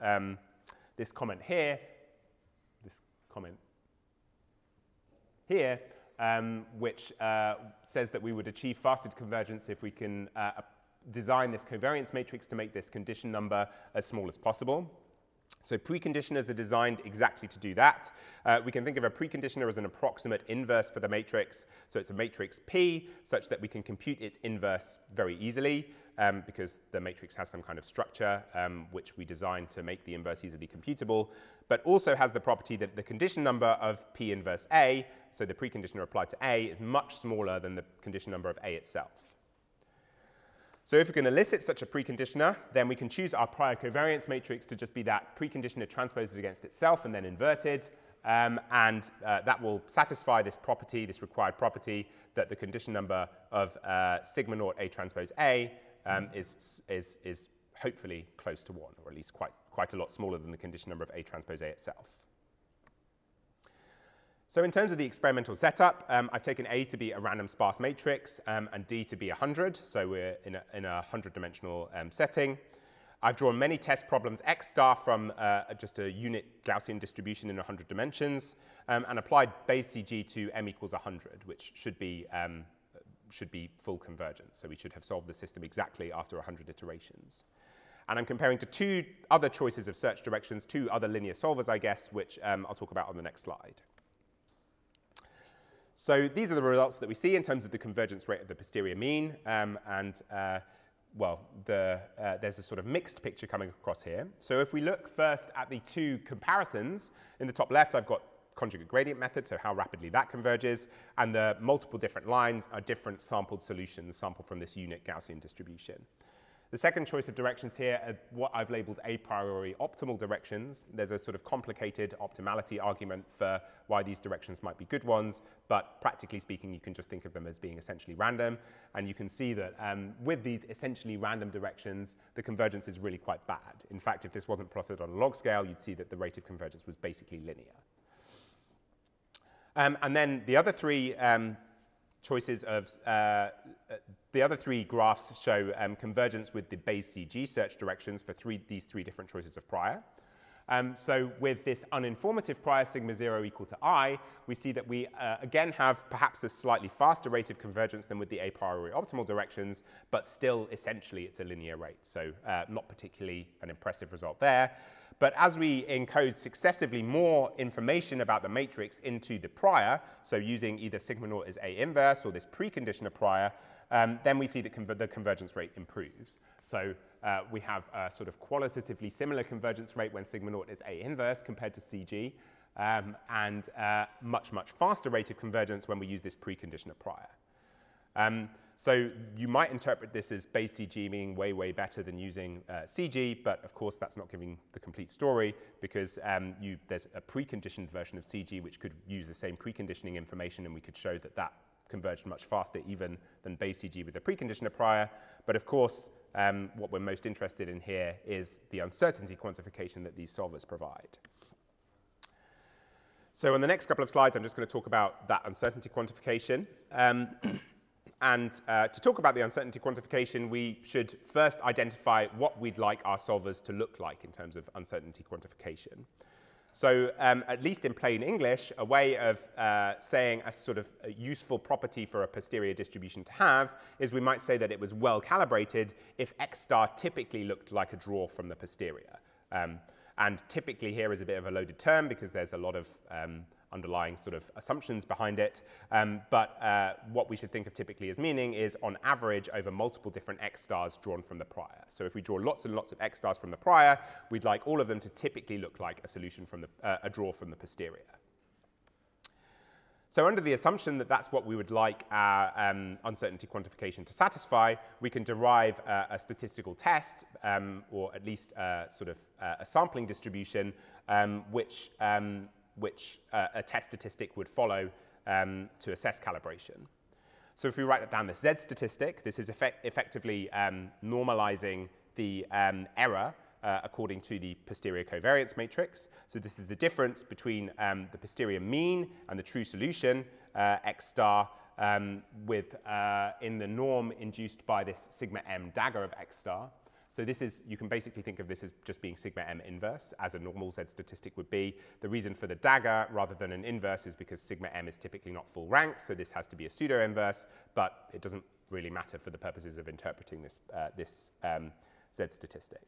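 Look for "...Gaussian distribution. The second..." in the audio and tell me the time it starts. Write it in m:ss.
1:55.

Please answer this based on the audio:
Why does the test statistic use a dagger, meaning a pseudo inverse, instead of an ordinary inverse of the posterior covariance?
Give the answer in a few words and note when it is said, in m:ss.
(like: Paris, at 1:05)
not full rank, at 5:05.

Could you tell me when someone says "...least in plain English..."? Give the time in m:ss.
3:47.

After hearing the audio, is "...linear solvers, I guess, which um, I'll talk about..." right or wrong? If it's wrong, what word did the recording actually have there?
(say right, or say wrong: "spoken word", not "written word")
right.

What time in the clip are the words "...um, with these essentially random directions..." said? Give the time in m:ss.
2:09.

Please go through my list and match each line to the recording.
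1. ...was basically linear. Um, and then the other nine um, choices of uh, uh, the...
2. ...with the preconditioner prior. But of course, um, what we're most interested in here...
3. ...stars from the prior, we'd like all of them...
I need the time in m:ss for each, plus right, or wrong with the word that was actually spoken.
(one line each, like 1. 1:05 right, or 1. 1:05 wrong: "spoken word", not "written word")
1. 2:16 wrong: "three", not "nine"
2. 3:24 right
3. 4:13 right.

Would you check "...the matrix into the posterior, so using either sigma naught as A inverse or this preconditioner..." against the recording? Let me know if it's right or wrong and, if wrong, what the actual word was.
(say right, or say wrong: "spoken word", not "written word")
wrong: "prior", not "posterior".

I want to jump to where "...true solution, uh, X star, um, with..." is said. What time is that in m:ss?
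4:49.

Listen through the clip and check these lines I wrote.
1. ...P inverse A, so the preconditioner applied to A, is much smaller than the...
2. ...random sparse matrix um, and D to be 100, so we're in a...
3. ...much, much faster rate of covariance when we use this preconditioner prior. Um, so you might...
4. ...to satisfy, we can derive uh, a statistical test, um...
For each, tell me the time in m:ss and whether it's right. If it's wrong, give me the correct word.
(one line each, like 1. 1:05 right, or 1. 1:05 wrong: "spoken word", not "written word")
1. 0:34 right
2. 1:07 right
3. 3:04 wrong: "convergence", not "covariance"
4. 4:24 right.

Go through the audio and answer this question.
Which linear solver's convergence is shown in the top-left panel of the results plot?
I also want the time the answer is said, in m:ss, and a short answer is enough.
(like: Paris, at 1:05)
conjugate gradient method, at 1:48.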